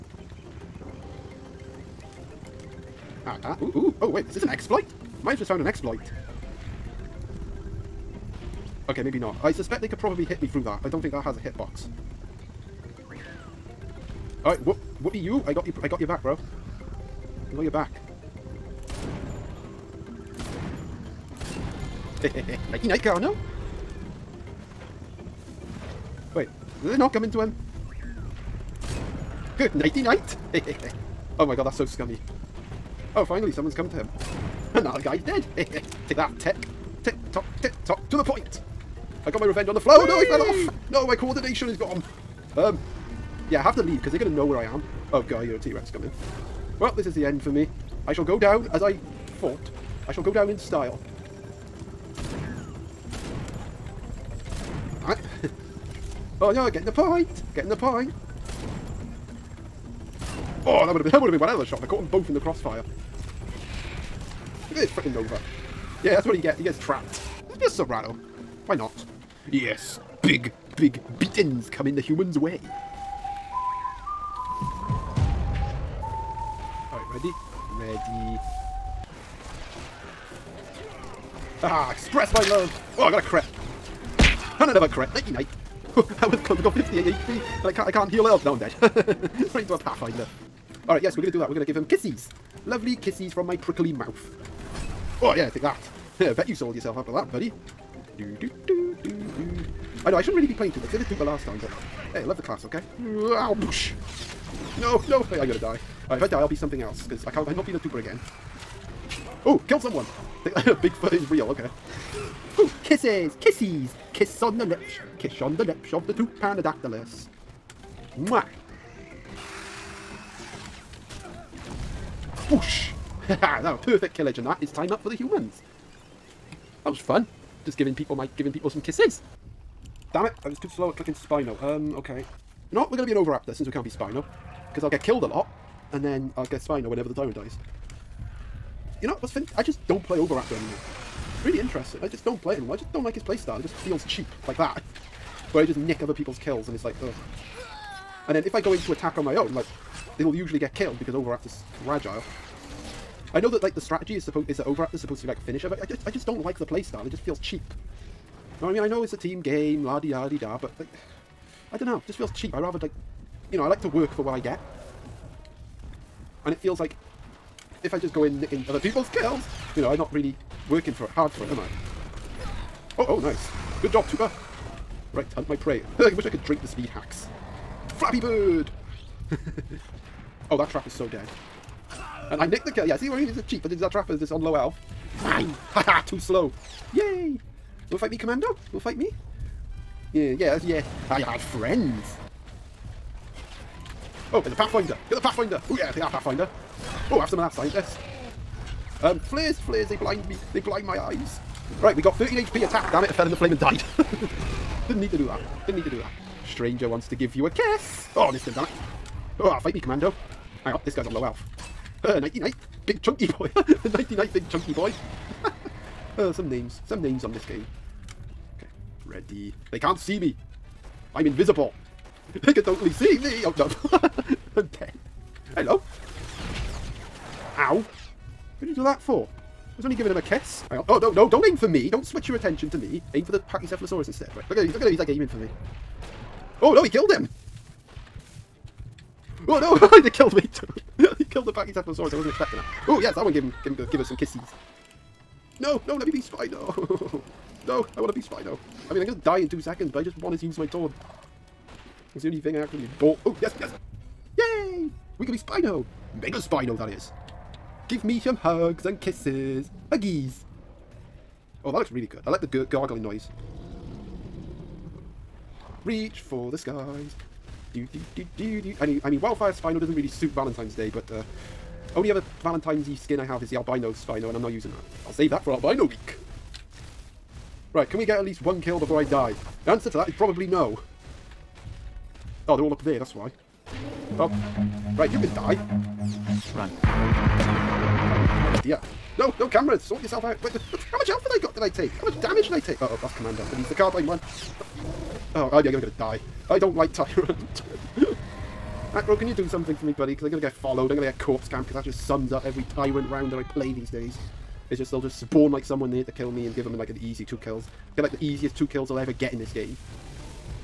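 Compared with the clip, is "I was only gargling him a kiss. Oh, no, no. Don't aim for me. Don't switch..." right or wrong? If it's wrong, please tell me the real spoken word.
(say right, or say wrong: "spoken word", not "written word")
wrong: "giving", not "gargling".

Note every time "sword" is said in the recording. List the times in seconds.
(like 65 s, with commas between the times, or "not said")
250 s.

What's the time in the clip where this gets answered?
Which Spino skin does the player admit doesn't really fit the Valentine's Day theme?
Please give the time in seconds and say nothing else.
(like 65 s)
269 s.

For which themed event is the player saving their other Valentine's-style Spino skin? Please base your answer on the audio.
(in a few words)
Albino Week.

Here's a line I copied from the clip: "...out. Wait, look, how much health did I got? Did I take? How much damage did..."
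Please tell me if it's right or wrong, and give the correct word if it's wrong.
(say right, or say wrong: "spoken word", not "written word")
right.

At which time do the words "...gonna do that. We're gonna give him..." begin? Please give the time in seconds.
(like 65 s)
91 s.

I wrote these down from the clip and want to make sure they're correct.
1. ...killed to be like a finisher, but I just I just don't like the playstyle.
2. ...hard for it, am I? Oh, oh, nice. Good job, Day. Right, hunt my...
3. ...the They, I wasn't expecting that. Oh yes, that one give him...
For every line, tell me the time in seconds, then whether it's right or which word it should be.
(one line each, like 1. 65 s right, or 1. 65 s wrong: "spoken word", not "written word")
1. 154 s wrong: "supposed", not "killed"
2. 171 s wrong: "Tupa", not "Day"
3. 241 s wrong: "Pachycephalosaurus", not "They".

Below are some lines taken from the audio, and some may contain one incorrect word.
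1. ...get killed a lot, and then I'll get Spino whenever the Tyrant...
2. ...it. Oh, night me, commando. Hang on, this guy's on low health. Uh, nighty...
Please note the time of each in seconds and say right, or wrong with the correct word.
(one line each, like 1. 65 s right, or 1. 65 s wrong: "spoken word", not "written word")
1. 134 s right
2. 208 s wrong: "fight", not "night".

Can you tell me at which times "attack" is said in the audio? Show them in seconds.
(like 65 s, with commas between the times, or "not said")
148 s, 202 s.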